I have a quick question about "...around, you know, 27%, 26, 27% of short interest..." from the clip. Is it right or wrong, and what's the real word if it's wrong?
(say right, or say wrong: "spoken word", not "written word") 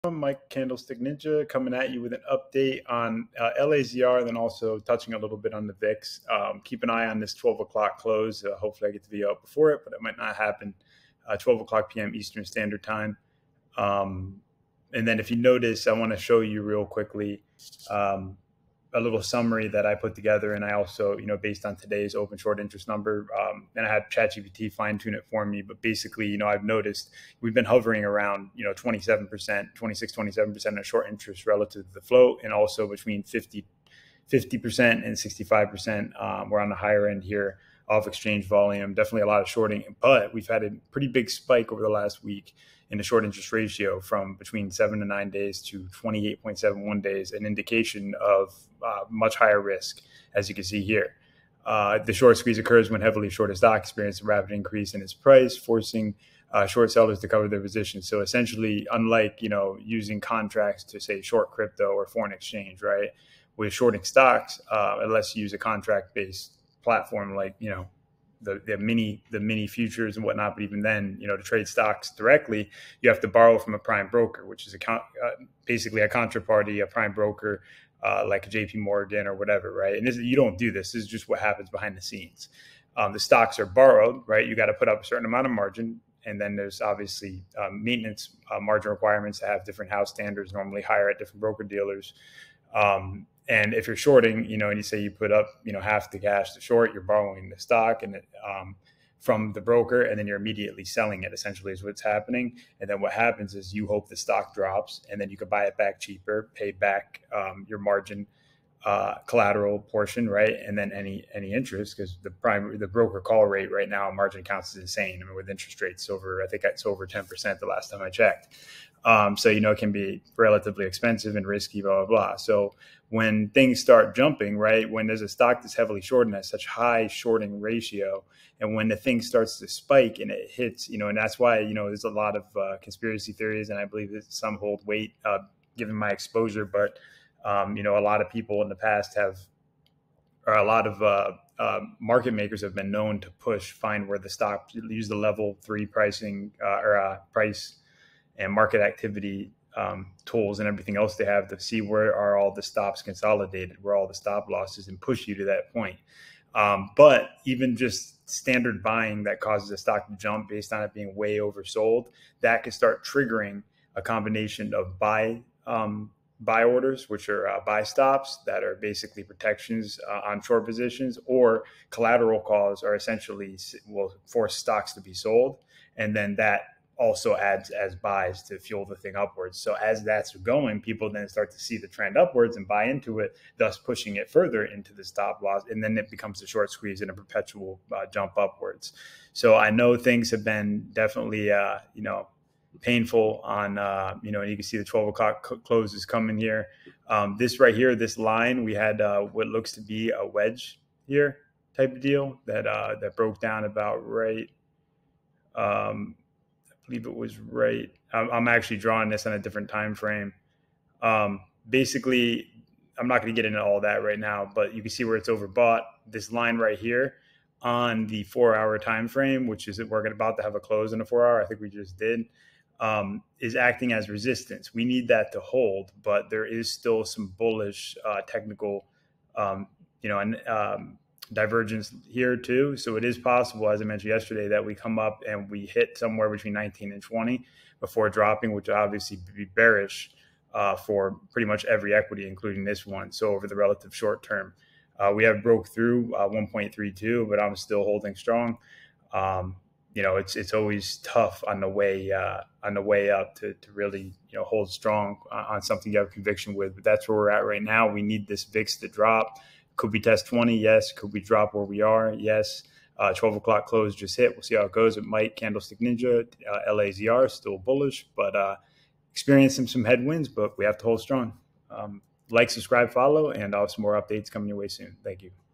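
right.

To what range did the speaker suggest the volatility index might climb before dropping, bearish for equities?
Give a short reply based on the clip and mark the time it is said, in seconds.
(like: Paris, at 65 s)
19 to 20, at 236 s.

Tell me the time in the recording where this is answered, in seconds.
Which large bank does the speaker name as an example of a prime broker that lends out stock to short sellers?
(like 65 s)
78 s.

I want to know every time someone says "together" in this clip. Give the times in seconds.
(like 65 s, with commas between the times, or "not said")
20 s.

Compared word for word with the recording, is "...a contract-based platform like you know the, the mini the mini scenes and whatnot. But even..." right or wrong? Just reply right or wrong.
wrong.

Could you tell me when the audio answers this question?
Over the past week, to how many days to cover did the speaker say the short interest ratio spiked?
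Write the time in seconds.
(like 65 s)
46 s.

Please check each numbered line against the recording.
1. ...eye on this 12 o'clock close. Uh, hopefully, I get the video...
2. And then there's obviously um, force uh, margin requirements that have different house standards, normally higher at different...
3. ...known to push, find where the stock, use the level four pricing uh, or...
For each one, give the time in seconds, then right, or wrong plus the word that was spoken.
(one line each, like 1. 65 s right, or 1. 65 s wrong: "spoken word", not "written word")
1. 6 s right
2. 86 s wrong: "maintenance", not "force"
3. 142 s wrong: "three", not "four".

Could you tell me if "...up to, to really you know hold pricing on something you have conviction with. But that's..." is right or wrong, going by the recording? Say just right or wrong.
wrong.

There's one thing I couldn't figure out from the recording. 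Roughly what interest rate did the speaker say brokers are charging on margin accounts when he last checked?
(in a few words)
over 10%.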